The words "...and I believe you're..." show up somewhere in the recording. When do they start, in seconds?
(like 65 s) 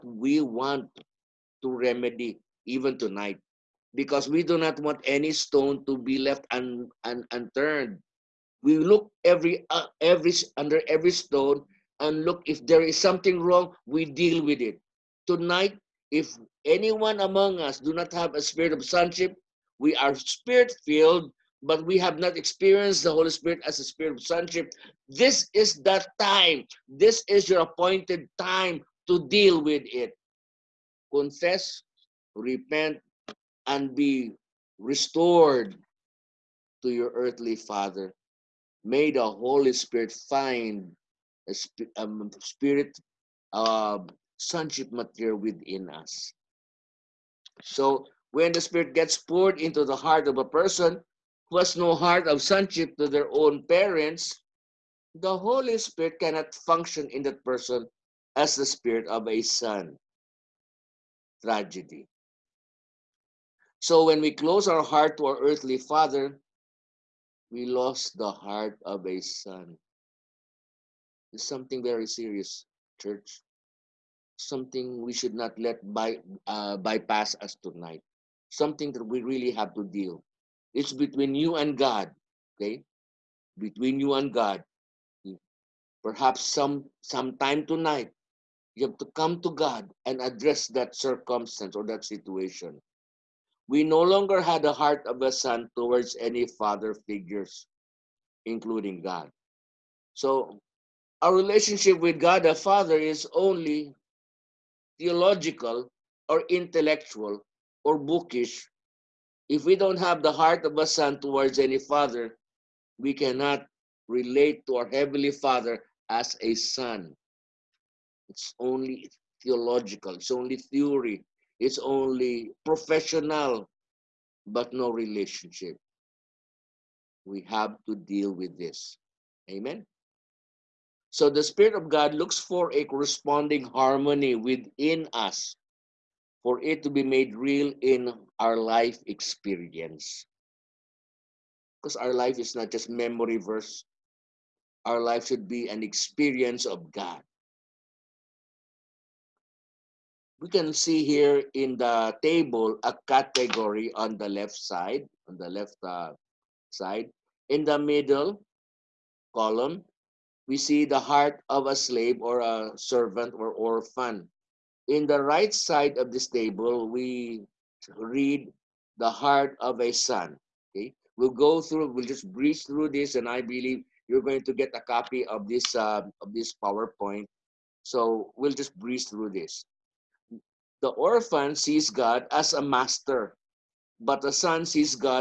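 173 s.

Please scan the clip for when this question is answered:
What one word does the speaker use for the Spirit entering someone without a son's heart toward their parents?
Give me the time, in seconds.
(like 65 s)
61 s.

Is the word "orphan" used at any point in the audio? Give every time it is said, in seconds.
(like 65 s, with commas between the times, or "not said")
163 s, 180 s.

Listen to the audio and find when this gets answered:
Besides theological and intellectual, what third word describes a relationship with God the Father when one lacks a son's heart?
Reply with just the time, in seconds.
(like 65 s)
107 s.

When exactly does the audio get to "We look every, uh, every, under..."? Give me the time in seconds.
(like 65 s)
8 s.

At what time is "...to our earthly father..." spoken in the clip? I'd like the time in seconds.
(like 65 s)
65 s.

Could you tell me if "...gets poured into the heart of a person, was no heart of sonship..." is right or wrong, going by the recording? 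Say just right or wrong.
right.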